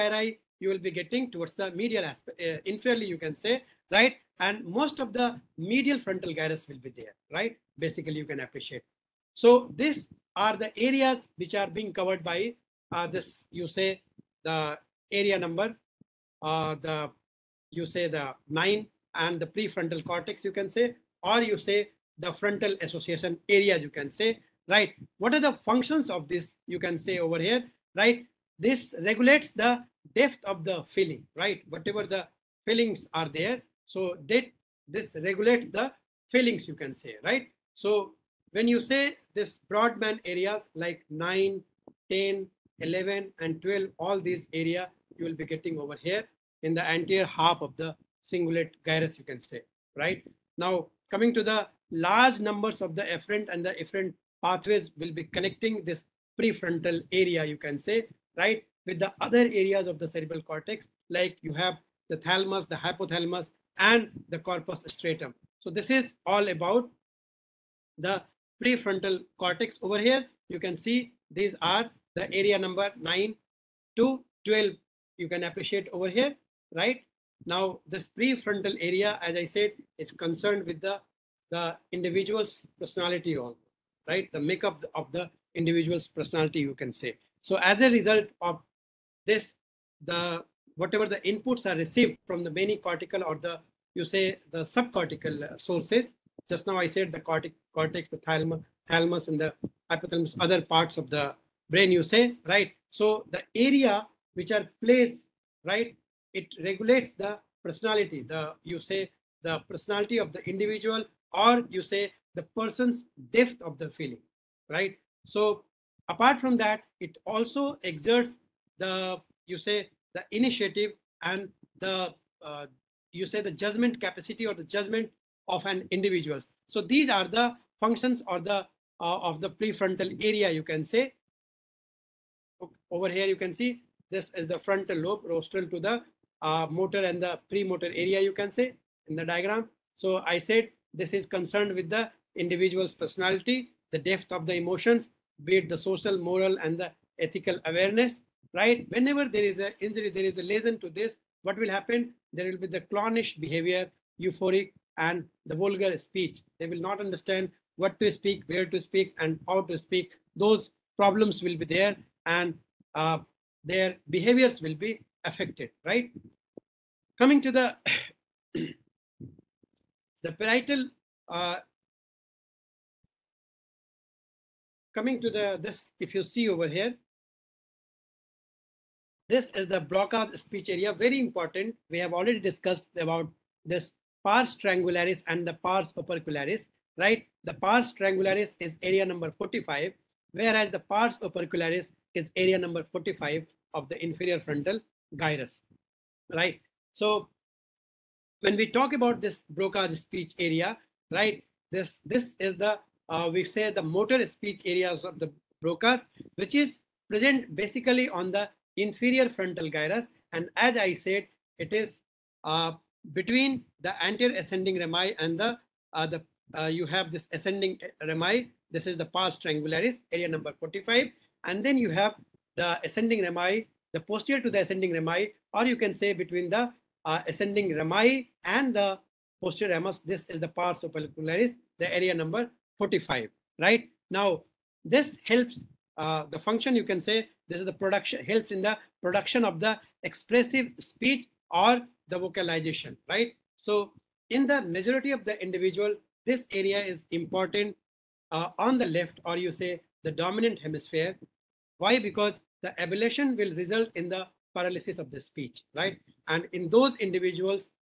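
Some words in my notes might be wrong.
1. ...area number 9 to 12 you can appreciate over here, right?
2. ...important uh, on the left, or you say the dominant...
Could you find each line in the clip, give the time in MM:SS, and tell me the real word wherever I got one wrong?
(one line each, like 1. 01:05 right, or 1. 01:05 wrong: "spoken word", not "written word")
1. 01:12 right
2. 04:07 right.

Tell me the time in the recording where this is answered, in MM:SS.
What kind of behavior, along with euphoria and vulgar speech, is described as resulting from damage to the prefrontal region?
02:32.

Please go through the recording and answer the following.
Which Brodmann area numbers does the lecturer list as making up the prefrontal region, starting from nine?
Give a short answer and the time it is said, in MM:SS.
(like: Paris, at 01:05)
9, 10, 11, and 12, at 00:41.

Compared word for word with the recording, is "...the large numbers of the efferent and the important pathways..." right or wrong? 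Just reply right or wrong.
wrong.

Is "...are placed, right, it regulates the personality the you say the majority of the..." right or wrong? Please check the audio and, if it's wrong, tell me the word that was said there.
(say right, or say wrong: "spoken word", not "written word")
wrong: "personality", not "majority".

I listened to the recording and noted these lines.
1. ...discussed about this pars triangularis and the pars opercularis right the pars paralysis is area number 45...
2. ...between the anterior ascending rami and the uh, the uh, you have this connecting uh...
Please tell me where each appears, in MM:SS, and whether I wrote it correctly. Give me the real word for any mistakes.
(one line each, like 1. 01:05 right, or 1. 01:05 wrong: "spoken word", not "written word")
1. 03:02 wrong: "triangularis", not "paralysis"
2. 03:33 wrong: "ascending", not "connecting".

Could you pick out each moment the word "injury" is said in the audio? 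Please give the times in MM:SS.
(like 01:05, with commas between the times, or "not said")
02:29.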